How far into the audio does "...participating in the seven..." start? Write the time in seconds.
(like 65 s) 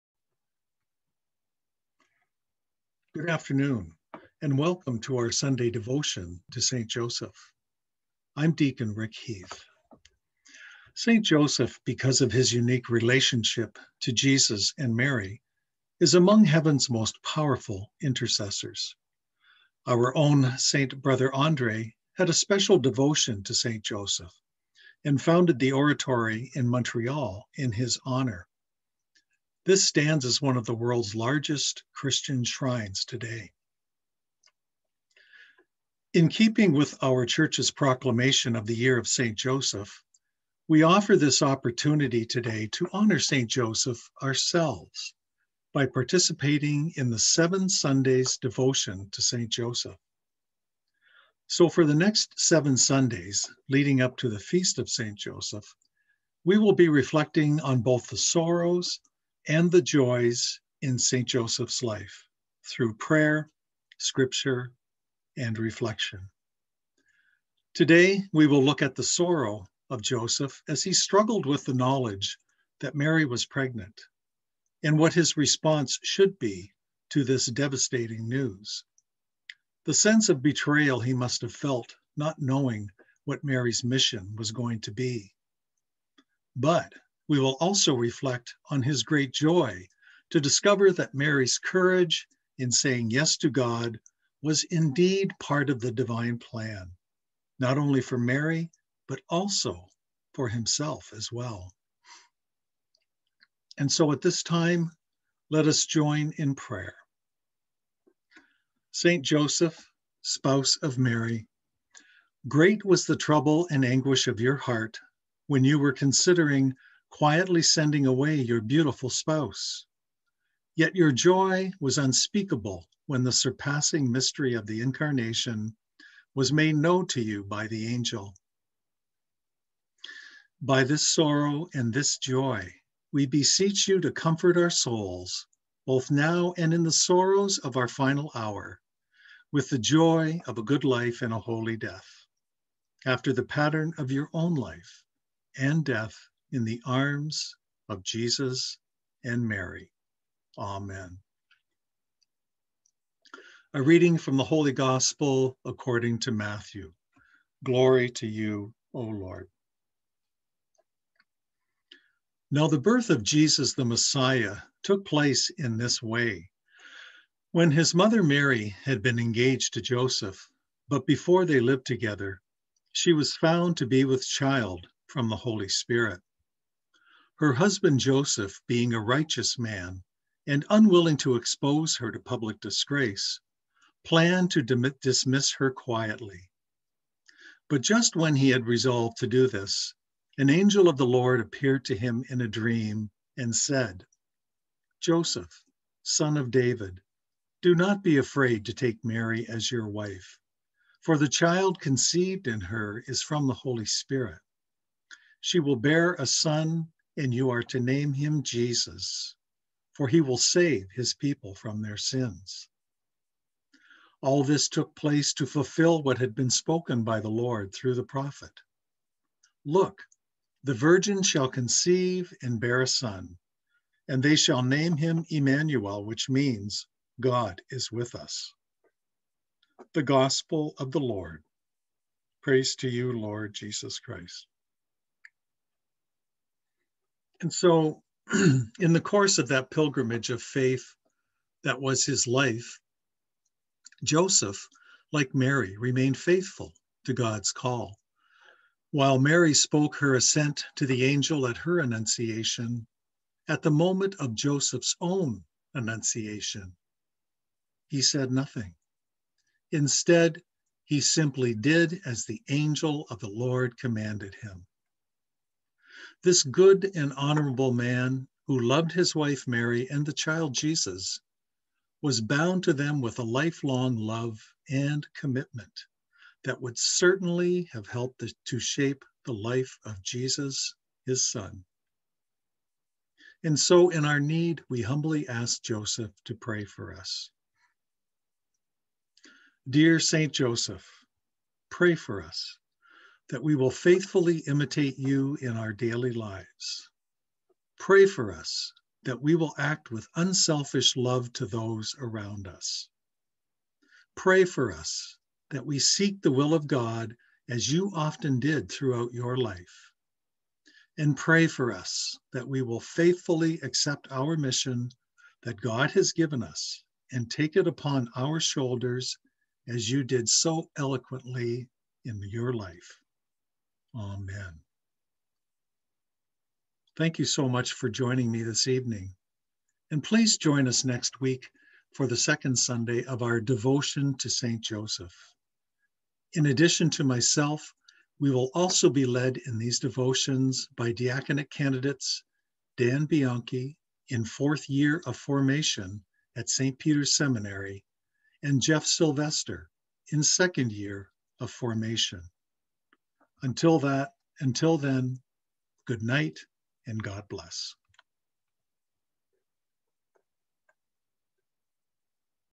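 45 s.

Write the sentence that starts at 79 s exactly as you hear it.
The sense of betrayal he must have felt, not knowing what Mary's mission was going to be.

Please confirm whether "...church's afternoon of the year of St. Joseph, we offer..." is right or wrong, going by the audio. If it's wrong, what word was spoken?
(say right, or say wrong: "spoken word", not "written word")
wrong: "proclamation", not "afternoon".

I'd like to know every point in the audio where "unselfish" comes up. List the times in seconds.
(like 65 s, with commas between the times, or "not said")
300 s.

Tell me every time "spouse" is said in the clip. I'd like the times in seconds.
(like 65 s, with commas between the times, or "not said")
110 s, 119 s.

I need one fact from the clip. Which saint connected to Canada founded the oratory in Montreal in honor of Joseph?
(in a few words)
St. Brother Andre.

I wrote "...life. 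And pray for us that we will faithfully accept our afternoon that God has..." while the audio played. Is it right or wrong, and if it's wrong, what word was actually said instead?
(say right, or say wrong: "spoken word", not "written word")
wrong: "mission", not "afternoon".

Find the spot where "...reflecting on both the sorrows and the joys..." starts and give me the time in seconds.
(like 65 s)
56 s.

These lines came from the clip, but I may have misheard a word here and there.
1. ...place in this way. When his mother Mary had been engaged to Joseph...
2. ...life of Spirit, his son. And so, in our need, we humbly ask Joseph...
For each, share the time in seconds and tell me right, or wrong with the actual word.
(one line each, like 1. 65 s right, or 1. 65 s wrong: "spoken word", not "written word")
1. 165 s right
2. 279 s wrong: "Jesus", not "Spirit".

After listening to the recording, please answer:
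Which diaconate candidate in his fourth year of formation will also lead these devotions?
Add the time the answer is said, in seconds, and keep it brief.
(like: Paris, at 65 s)
Dan Bianchi, at 342 s.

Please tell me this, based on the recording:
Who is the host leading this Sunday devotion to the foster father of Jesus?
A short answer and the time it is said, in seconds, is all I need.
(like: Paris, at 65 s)
Deacon Rick Heath, at 8 s.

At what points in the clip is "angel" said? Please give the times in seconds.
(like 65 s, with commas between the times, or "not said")
127 s, 190 s, 251 s, 262 s.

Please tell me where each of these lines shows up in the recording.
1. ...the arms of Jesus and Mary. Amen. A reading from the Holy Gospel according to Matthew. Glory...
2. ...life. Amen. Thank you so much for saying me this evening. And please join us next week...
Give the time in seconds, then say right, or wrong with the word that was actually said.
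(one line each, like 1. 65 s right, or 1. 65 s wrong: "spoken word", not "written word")
1. 146 s right
2. 322 s wrong: "joining", not "saying".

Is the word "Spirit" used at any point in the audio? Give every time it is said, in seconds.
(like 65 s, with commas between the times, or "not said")
175 s, 203 s.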